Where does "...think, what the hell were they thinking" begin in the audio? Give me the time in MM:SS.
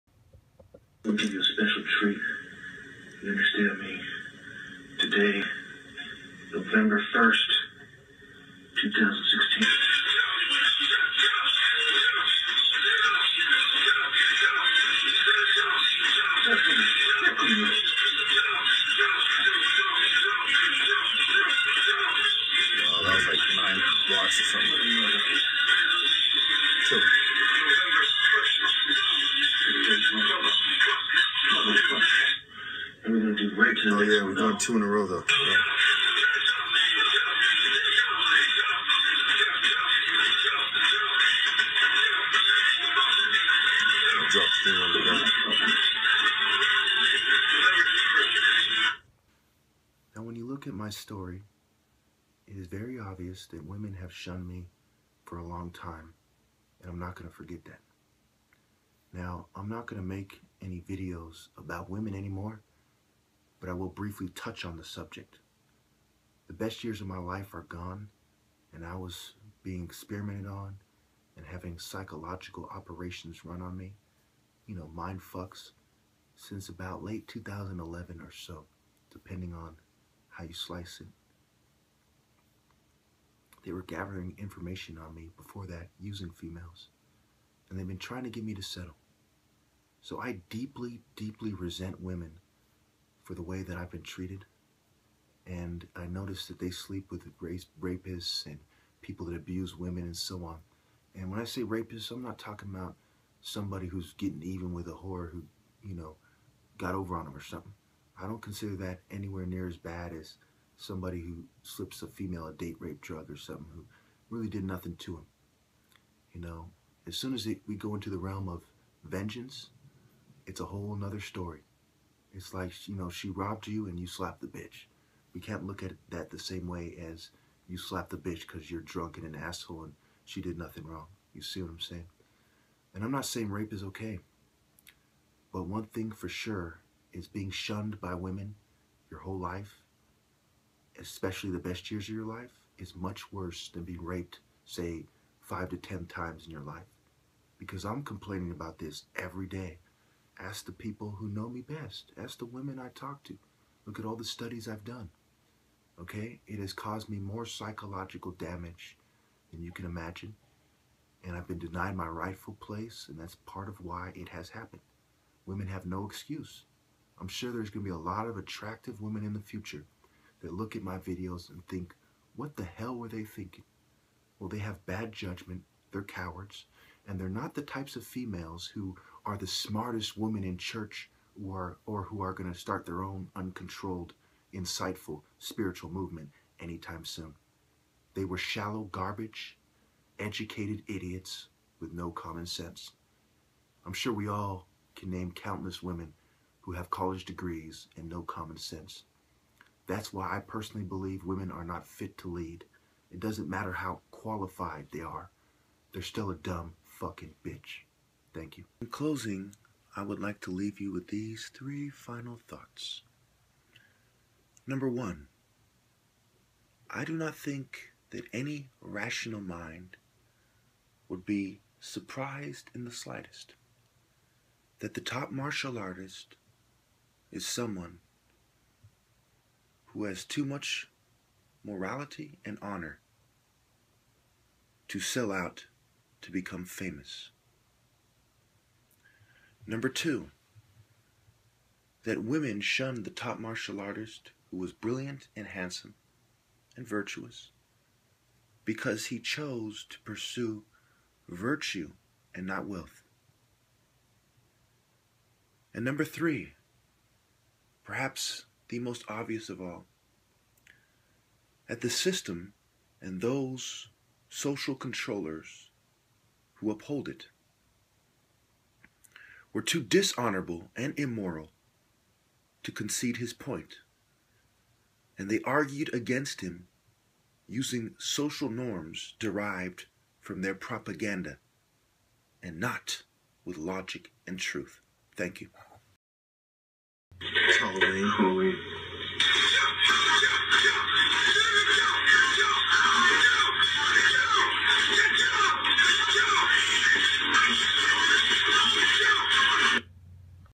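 02:51.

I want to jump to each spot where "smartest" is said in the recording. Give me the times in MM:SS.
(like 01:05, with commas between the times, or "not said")
02:59.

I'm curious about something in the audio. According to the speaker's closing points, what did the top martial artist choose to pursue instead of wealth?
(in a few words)
virtue.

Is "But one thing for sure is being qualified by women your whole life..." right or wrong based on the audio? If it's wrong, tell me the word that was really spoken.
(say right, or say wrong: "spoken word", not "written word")
wrong: "shunned", not "qualified".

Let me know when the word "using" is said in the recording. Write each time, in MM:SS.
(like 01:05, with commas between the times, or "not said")
01:25, 04:37.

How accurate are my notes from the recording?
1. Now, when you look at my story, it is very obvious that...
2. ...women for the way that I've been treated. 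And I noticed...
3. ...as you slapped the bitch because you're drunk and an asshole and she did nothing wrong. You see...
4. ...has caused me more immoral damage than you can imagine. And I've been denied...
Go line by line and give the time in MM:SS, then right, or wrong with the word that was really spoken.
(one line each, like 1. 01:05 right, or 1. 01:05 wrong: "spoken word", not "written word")
1. 00:50 right
2. 01:32 right
3. 02:06 right
4. 02:36 wrong: "psychological", not "immoral".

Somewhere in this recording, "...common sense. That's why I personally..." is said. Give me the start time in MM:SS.
03:18.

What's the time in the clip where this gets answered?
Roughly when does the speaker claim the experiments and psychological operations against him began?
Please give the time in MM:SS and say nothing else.
01:17.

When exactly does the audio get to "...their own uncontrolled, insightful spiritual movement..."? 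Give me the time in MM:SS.
03:02.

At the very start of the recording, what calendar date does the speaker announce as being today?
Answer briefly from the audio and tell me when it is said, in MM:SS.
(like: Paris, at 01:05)
November 1, 2016, at 00:06.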